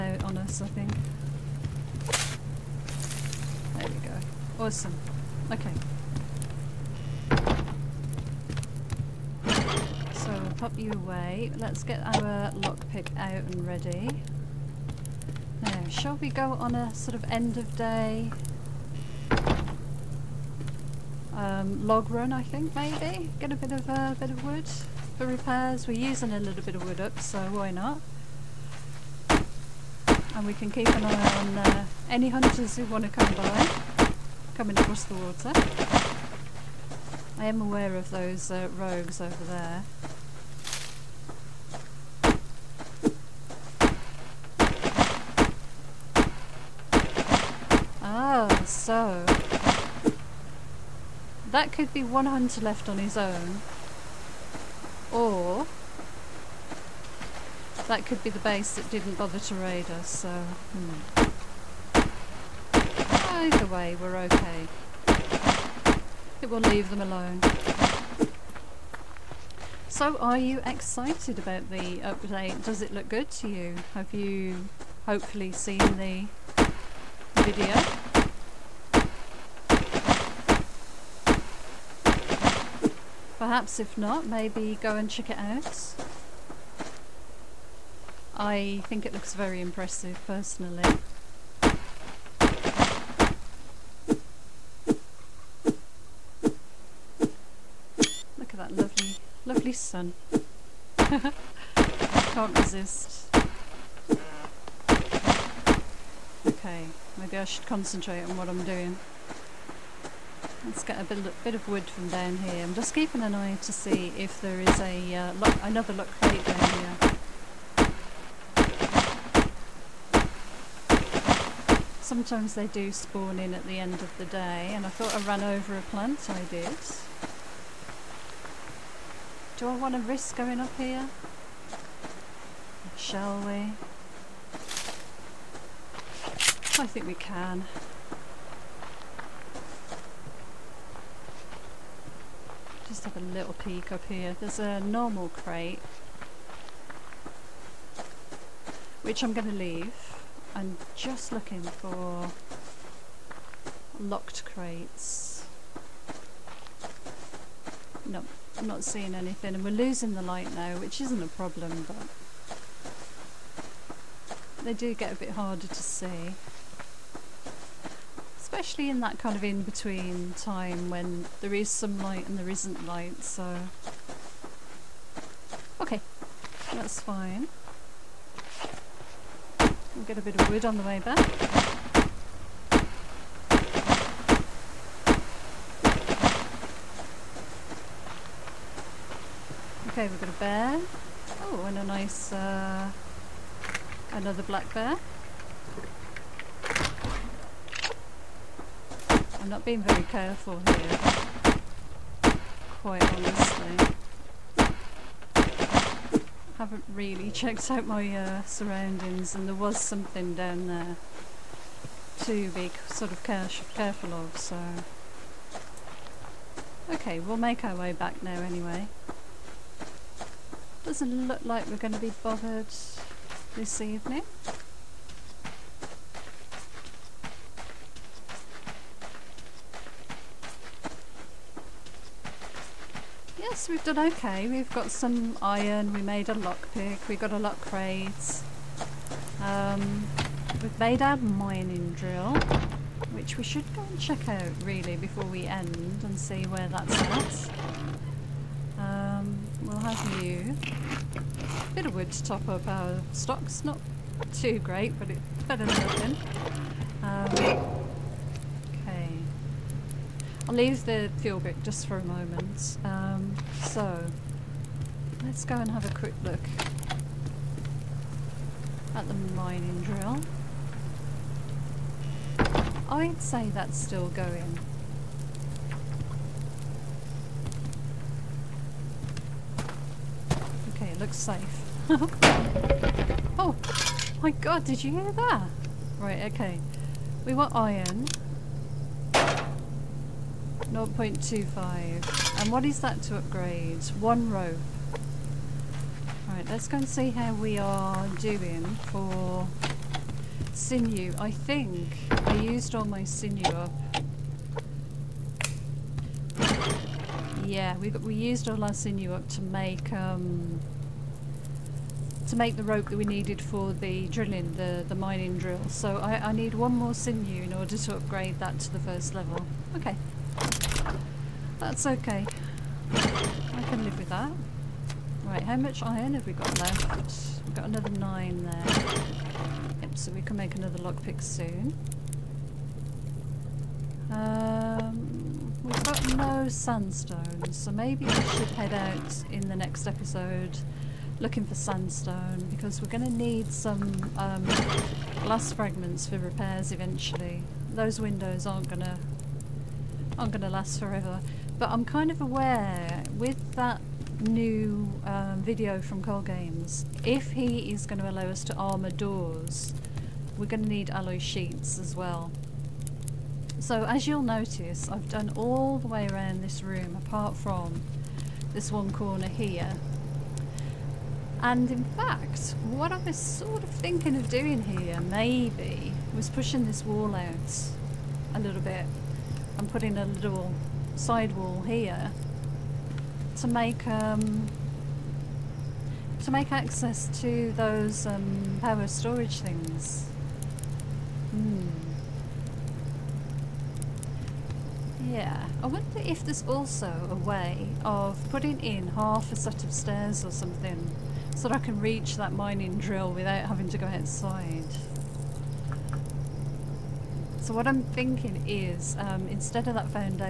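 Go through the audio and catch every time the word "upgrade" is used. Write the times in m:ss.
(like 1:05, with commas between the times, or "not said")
4:53, 5:17.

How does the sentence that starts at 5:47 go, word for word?
Those windows aren't going to aren't going to last forever.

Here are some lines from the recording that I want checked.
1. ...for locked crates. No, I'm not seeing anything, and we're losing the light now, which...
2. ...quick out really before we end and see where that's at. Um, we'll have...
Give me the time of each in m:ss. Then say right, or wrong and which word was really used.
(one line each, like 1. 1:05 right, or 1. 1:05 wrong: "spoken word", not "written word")
1. 2:31 right
2. 4:04 wrong: "check", not "quick".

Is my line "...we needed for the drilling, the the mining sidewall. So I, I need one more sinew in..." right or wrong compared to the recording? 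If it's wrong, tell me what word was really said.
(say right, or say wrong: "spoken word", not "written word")
wrong: "drill", not "sidewall".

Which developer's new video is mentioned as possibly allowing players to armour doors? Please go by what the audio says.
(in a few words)
Cold Games.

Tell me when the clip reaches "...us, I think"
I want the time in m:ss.
0:00.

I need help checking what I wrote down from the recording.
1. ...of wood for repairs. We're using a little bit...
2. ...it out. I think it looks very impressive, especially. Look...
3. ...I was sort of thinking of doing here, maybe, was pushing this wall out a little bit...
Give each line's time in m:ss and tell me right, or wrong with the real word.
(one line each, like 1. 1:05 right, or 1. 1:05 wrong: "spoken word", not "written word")
1. 0:24 right
2. 1:25 wrong: "personally", not "especially"
3. 6:12 right.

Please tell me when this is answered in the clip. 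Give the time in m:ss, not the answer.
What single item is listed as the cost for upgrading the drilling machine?
4:54.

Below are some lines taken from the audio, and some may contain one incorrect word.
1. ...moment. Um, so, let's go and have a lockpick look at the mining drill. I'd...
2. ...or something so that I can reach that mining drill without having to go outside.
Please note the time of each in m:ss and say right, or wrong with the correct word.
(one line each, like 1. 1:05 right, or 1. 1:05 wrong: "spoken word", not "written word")
1. 4:22 wrong: "quick", not "lockpick"
2. 6:40 right.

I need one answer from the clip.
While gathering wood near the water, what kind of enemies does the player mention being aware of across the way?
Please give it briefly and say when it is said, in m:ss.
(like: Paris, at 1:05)
rogues, at 0:38.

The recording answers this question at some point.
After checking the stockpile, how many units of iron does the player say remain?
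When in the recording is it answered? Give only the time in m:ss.
5:27.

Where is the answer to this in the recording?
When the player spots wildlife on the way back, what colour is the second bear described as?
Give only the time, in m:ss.
3:14.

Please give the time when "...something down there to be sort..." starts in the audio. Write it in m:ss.
3:29.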